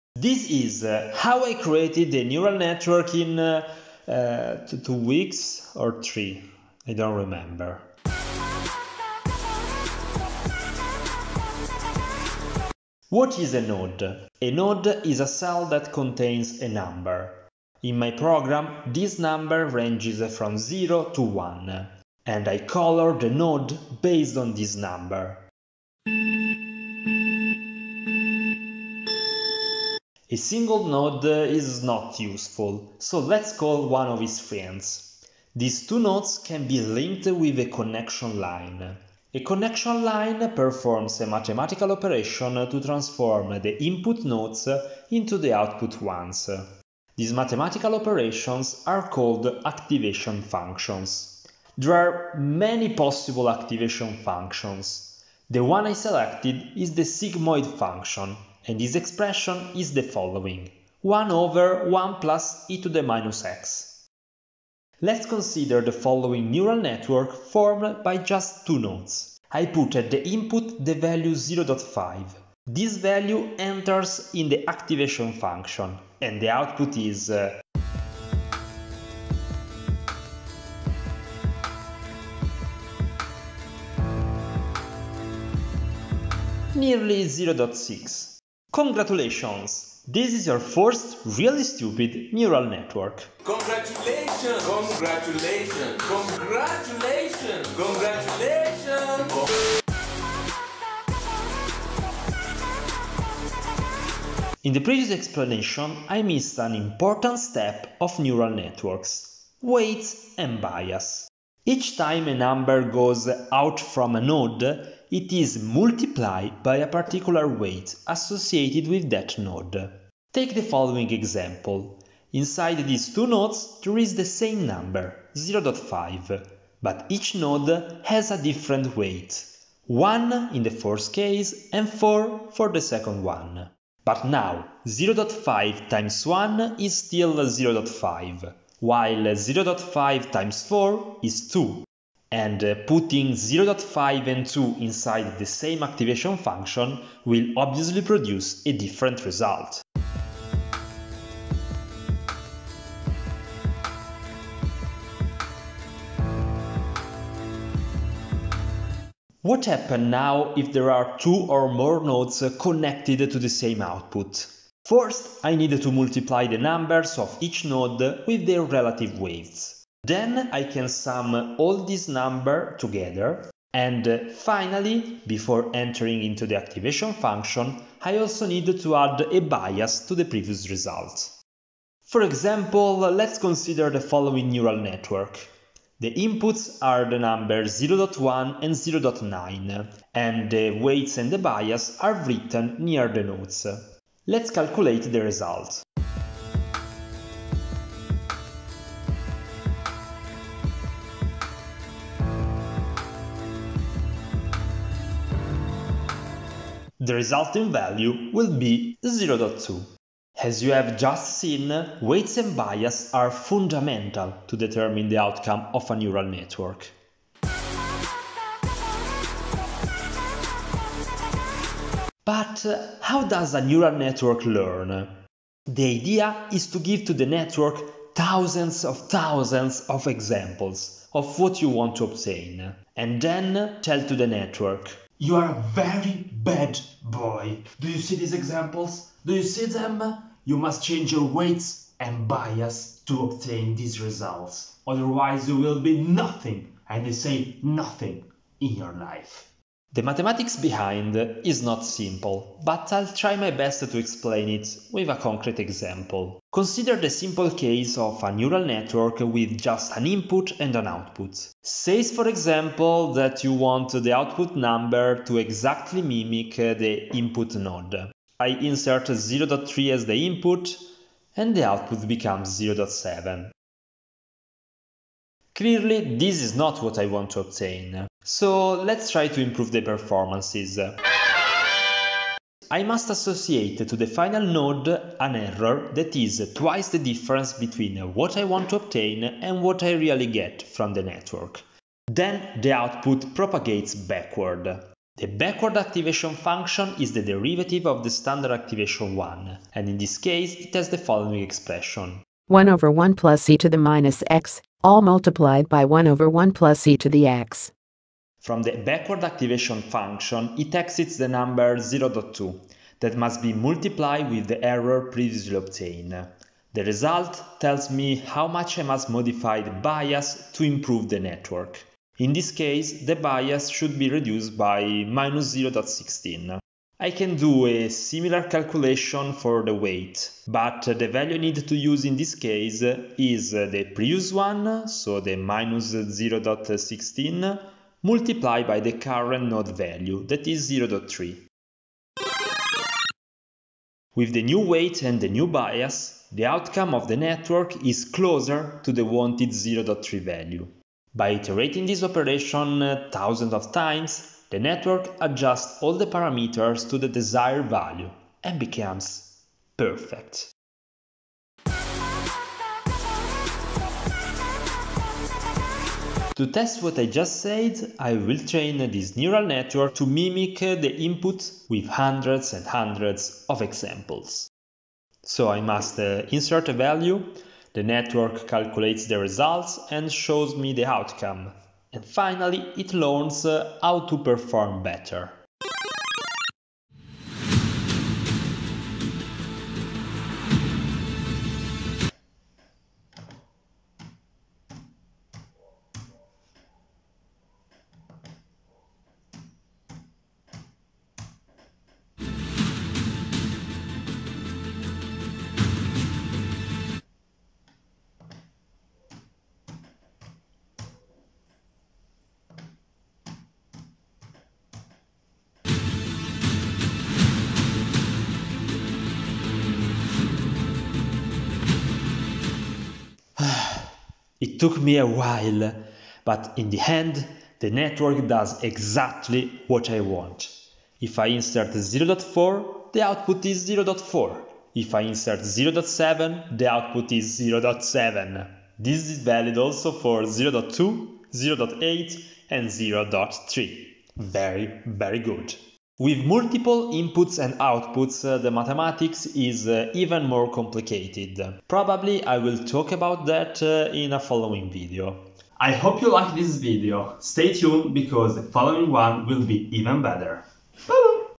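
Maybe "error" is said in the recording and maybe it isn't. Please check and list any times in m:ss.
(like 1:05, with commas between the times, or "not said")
4:45, 5:14.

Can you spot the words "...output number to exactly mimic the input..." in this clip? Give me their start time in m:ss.
4:24.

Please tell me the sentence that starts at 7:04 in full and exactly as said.
It took me a while, but in the end, the network does exactly what I want.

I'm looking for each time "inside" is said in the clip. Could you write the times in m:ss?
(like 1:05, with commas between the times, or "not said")
2:02, 2:24.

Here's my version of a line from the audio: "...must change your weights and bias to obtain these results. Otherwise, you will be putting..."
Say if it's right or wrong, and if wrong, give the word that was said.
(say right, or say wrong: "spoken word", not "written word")
wrong: "nothing", not "putting".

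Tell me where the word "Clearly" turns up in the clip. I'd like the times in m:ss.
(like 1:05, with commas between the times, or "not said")
4:35.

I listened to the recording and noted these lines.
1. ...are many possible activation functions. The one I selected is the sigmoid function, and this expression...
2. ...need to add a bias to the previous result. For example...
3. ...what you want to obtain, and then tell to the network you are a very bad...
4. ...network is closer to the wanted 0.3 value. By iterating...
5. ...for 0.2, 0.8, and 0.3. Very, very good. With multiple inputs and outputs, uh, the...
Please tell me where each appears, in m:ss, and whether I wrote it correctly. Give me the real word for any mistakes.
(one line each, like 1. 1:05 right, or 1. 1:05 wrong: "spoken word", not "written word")
1. 0:51 right
2. 2:58 right
3. 3:51 right
4. 5:47 right
5. 7:19 right.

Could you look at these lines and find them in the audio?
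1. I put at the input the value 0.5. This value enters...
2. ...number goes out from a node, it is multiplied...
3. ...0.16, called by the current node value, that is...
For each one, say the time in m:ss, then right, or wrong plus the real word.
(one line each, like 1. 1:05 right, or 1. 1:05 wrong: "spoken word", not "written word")
1. 1:09 right
2. 1:52 right
3. 5:35 wrong: "multiplied", not "called".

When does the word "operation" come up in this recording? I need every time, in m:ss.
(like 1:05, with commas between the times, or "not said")
0:41, 0:47, 5:52.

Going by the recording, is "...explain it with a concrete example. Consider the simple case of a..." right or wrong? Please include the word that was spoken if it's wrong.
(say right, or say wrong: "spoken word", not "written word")
right.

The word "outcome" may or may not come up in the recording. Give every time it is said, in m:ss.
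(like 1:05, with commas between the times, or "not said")
3:35, 5:46, 6:20.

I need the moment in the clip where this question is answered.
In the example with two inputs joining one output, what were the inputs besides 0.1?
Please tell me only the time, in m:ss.
3:08.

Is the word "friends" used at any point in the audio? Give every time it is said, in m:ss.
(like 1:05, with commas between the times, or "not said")
0:34.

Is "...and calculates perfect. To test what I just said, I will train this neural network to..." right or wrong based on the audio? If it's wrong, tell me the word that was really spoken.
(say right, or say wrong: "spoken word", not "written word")
wrong: "becomes", not "calculates".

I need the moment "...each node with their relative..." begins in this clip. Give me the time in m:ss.
2:47.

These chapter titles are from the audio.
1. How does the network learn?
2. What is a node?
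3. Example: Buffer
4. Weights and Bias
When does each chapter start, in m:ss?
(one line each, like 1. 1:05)
1. 3:38
2. 0:11
3. 6:06
4. 1:39.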